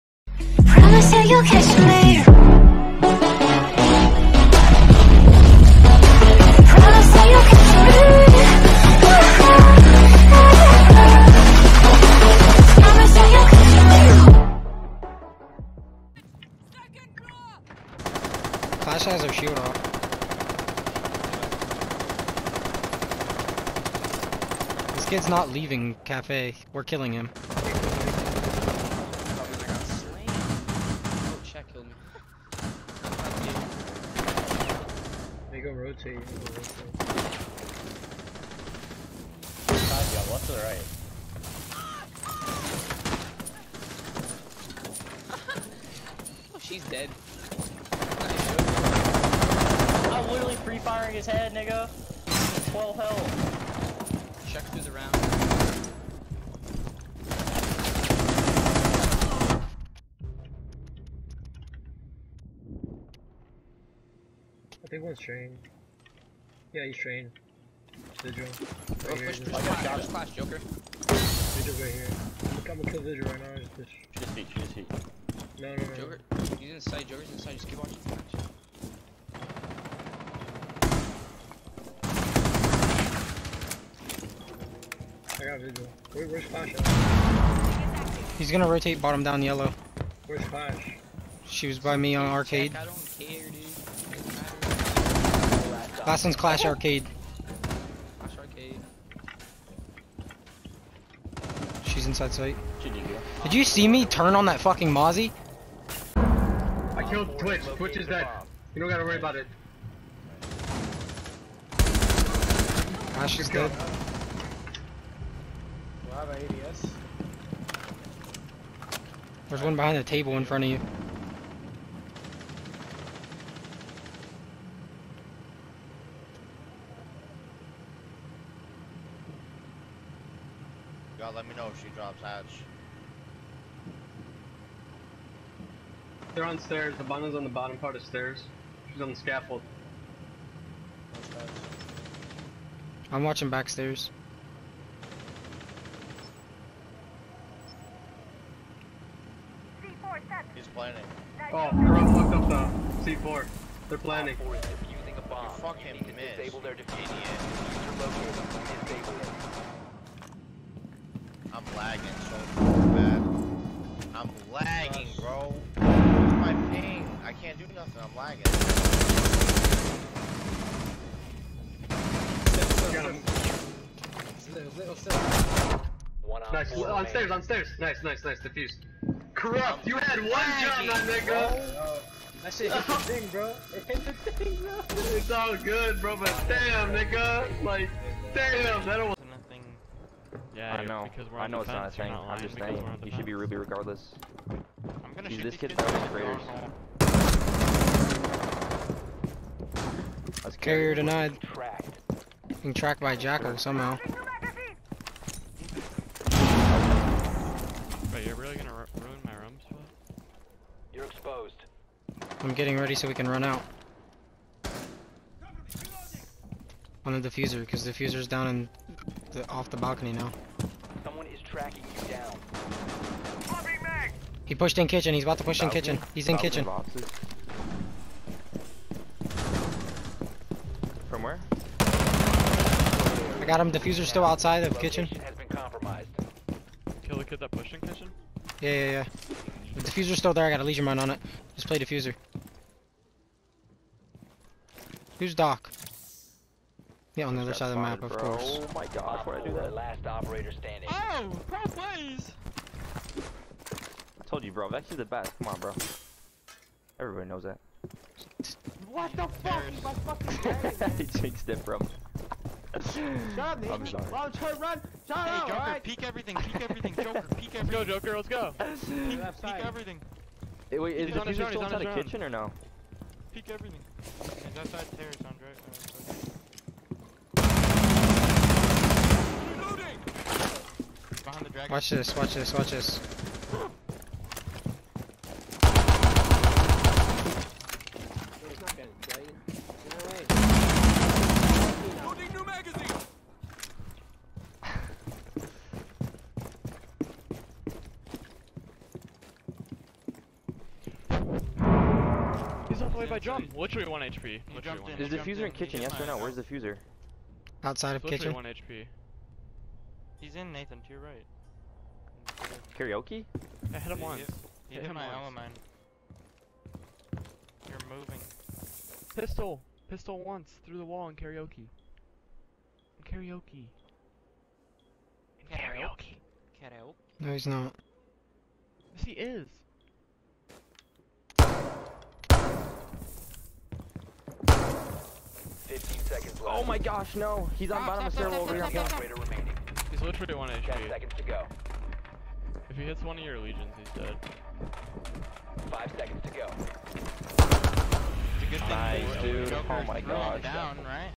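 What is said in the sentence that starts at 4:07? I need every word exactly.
Yeah, on the other side of the map, of bro.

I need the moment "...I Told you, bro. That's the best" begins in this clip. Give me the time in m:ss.
4:11.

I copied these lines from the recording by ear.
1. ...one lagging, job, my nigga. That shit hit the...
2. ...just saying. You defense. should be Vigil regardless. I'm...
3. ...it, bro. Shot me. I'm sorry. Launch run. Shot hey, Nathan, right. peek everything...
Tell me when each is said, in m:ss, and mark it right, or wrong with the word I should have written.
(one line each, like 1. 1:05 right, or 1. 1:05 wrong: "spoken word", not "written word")
1. 3:00 right
2. 3:12 wrong: "Ruby", not "Vigil"
3. 4:21 wrong: "Joker", not "Nathan".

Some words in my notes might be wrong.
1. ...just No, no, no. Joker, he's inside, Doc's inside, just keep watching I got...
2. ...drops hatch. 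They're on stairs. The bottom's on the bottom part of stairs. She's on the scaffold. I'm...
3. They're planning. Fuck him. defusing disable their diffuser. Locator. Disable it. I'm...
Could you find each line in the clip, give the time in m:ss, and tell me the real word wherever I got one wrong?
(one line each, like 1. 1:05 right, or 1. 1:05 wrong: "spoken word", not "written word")
1. 1:14 wrong: "Joker", not "Doc"
2. 2:11 right
3. 2:33 right.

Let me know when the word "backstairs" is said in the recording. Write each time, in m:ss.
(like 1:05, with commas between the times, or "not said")
2:23.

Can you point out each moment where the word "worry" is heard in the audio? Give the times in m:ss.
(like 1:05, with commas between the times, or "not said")
1:49.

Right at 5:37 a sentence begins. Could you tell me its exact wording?
He's on ah, bottom stop, of stairwell over stop, here.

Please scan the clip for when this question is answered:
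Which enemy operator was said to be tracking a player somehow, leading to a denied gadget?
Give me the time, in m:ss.
3:23.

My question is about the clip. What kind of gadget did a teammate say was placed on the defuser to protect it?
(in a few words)
Lesion mine.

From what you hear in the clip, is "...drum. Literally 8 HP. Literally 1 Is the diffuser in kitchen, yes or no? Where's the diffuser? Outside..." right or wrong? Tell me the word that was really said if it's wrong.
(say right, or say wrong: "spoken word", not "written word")
wrong: "1", not "8".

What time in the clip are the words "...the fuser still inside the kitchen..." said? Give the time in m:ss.
4:31.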